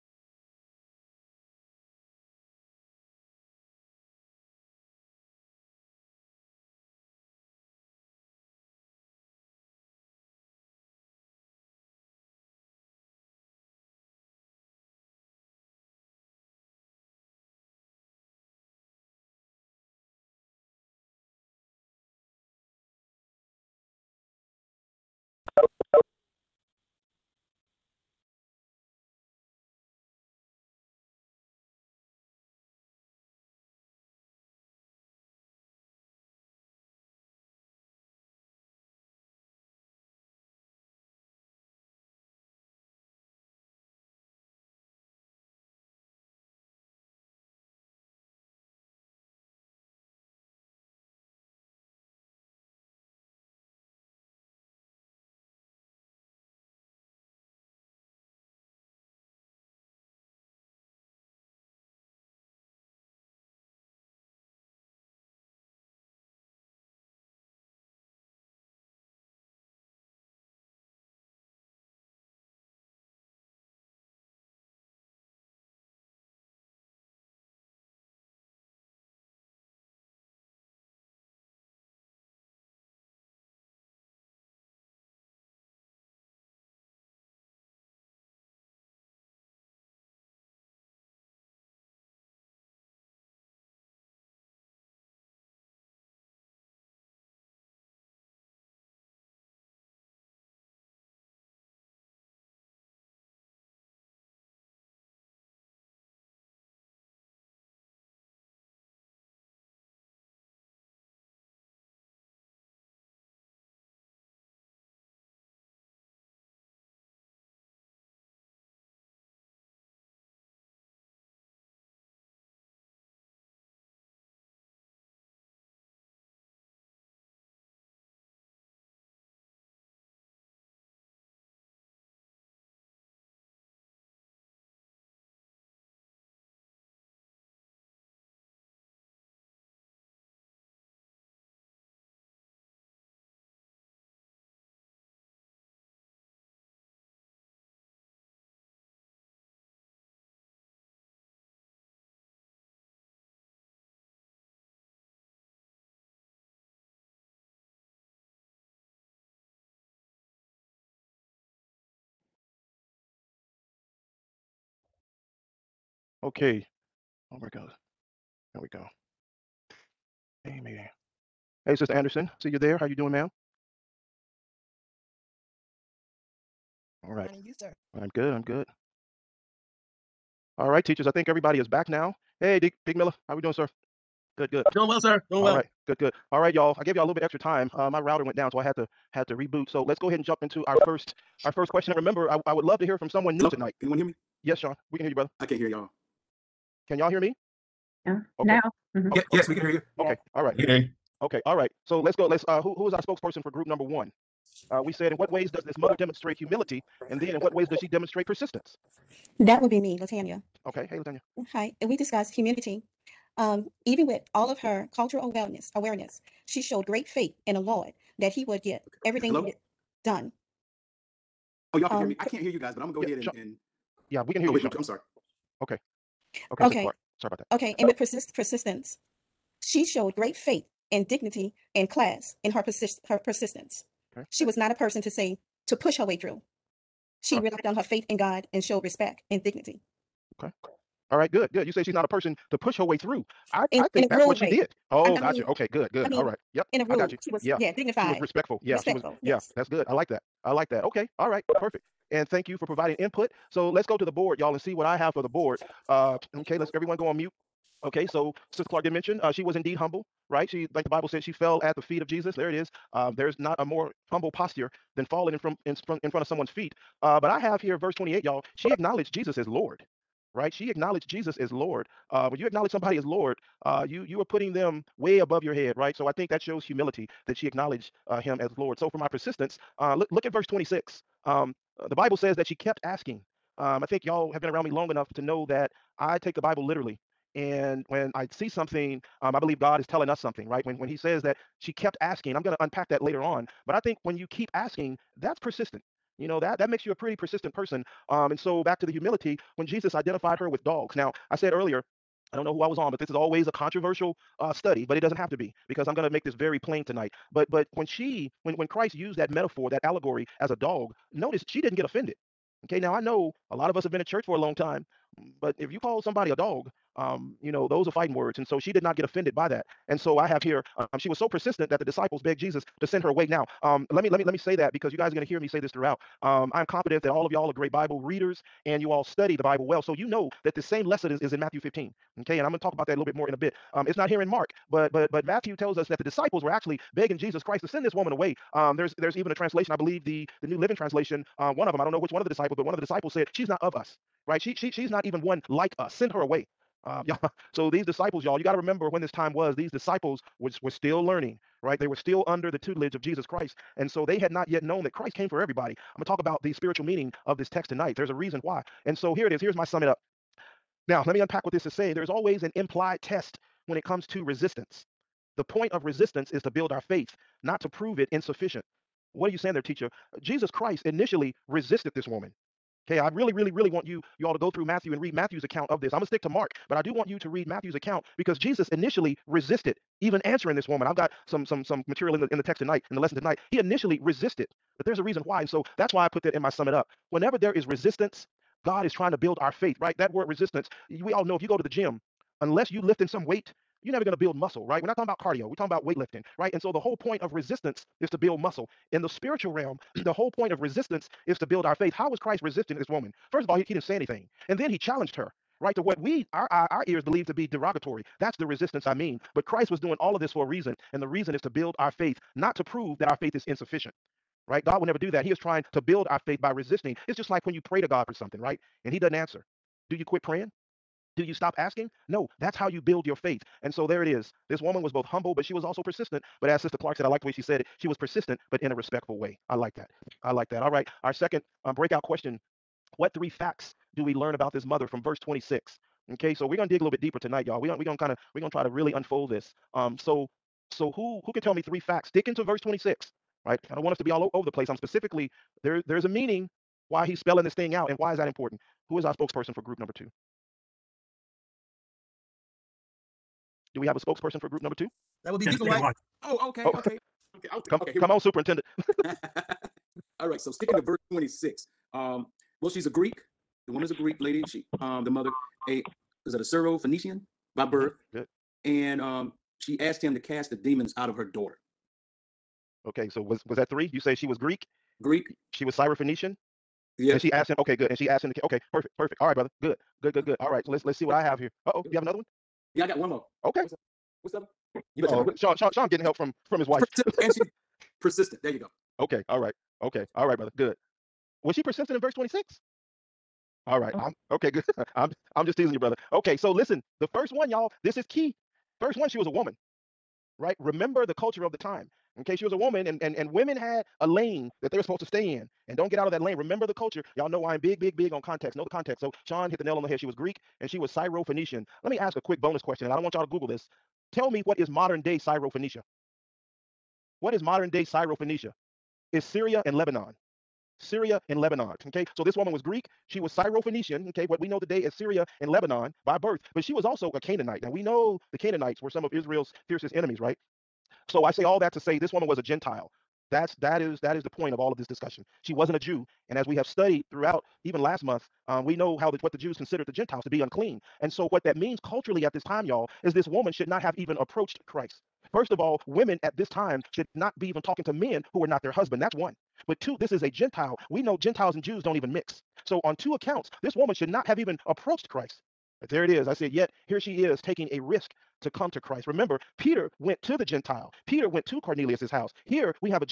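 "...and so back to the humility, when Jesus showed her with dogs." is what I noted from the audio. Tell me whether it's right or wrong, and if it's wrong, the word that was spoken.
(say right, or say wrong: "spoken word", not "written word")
wrong: "identified", not "showed".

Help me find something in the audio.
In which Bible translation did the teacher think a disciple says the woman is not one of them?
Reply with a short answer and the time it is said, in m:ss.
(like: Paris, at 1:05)
New Living Translation, at 5:40.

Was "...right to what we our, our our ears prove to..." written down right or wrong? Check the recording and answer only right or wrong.
wrong.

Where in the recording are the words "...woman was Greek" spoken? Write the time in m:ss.
8:42.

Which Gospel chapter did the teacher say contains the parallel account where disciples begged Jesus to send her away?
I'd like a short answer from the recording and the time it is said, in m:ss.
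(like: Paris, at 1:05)
Matthew 15, at 5:31.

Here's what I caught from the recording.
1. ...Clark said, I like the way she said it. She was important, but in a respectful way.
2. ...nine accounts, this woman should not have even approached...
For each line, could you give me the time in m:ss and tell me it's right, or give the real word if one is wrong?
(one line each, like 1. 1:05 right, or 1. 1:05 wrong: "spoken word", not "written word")
1. 7:06 wrong: "persistent", not "important"
2. 9:12 wrong: "two", not "nine".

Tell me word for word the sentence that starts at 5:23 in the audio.
Now, um, let me let me let me say that because you guys are going to hear me say this throughout.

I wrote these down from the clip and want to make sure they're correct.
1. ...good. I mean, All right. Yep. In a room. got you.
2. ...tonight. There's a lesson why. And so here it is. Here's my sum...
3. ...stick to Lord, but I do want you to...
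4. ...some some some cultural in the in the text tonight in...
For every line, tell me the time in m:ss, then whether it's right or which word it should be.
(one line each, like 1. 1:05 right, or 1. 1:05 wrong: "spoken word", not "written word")
1. 4:05 right
2. 5:57 wrong: "reason", not "lesson"
3. 6:16 wrong: "Mark", not "Lord"
4. 6:21 wrong: "material", not "cultural".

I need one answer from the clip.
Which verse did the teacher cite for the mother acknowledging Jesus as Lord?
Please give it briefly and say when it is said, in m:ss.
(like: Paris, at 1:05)
Verse 28, at 4:27.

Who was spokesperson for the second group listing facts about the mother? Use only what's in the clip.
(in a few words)
Deacon White.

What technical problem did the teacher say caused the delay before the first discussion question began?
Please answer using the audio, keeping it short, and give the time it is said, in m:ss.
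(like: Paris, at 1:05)
Router went down, at 3:07.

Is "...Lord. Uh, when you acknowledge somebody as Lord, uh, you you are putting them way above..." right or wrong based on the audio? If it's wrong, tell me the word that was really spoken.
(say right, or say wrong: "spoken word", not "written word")
right.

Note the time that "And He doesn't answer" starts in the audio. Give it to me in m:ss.
6:58.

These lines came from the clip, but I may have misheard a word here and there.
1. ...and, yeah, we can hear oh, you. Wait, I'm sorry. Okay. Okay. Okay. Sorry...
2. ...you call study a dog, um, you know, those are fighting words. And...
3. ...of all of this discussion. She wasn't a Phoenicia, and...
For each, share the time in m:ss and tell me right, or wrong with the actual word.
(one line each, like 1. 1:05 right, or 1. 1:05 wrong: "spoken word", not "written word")
1. 3:43 right
2. 5:15 wrong: "somebody", not "study"
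3. 8:54 wrong: "Jew", not "Phoenicia".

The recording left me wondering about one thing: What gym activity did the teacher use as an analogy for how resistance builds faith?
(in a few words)
Weightlifting.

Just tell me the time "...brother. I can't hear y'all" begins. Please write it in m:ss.
3:15.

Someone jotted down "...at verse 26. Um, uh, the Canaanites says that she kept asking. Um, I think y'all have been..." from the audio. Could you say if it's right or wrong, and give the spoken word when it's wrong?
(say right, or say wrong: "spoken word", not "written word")
wrong: "Bible", not "Canaanites".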